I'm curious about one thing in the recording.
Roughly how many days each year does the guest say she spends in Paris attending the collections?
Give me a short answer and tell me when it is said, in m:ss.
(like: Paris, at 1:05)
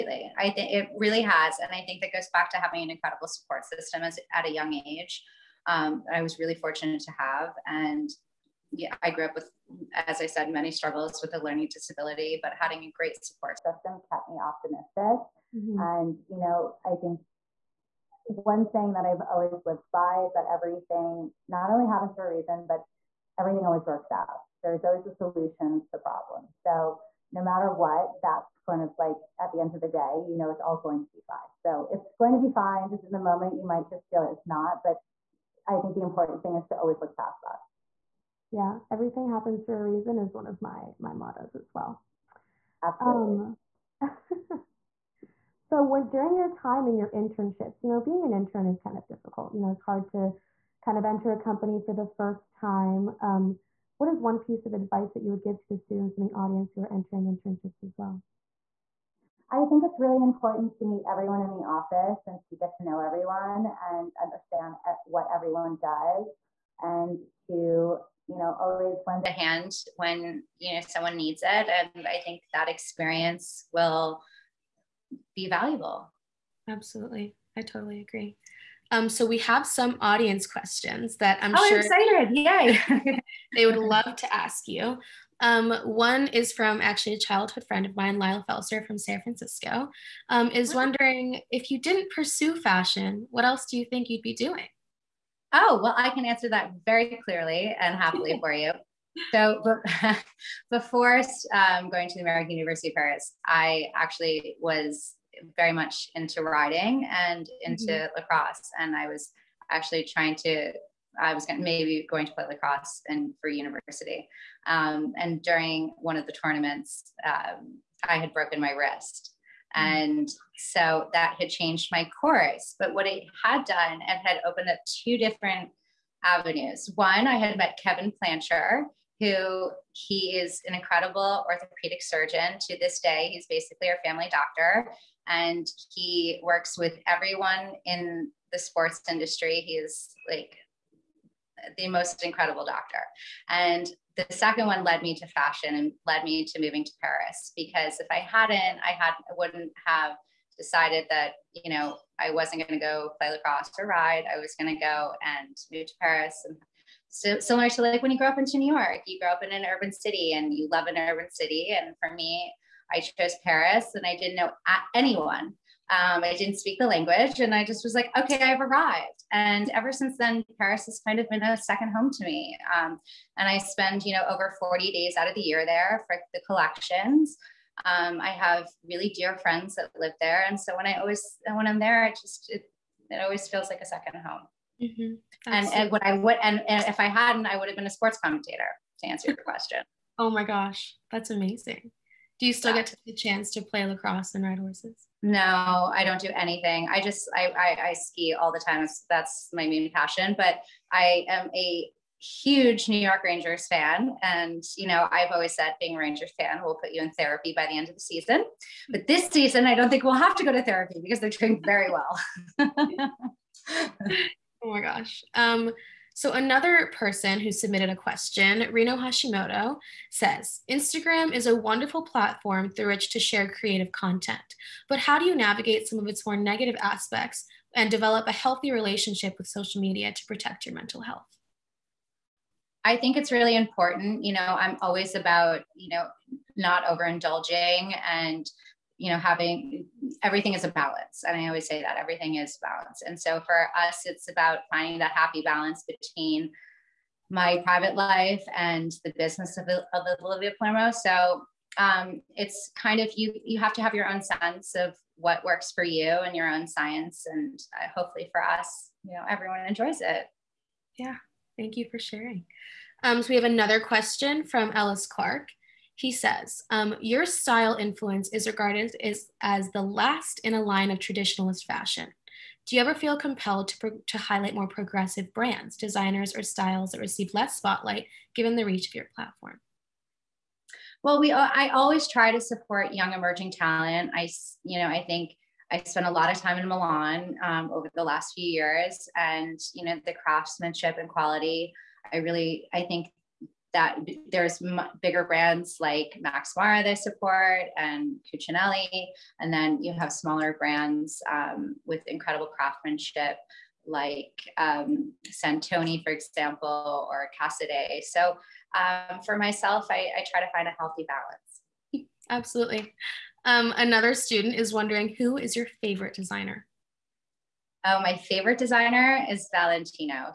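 40, at 2:54.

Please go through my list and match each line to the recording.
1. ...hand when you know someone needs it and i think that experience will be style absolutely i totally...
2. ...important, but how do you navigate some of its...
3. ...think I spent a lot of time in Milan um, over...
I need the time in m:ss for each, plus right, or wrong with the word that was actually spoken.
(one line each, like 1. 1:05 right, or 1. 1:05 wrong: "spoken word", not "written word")
1. 1:09 wrong: "valuable", not "style"
2. 3:43 wrong: "content", not "important"
3. 4:45 right.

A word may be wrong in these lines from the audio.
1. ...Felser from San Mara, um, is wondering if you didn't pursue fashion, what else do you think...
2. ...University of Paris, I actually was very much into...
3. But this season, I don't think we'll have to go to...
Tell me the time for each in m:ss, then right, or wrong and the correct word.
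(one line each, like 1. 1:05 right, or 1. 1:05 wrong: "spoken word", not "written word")
1. 1:28 wrong: "Francisco", not "Mara"
2. 1:42 right
3. 3:28 right.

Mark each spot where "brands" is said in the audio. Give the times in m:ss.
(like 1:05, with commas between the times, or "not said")
4:35, 4:55, 5:00.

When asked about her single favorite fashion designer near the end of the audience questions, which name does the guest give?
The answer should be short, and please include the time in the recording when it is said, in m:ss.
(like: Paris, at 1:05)
Valentino, at 5:19.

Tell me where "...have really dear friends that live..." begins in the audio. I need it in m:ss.
2:58.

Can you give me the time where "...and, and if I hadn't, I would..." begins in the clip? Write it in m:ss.
3:06.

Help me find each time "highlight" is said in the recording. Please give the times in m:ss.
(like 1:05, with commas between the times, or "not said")
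4:34.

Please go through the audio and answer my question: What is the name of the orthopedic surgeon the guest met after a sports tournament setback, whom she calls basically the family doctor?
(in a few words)
Kevin Plancher.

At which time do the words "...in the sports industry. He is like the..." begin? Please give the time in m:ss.
2:17.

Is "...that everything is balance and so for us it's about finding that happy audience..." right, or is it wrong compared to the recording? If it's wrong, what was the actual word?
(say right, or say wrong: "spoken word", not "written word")
wrong: "balance", not "audience".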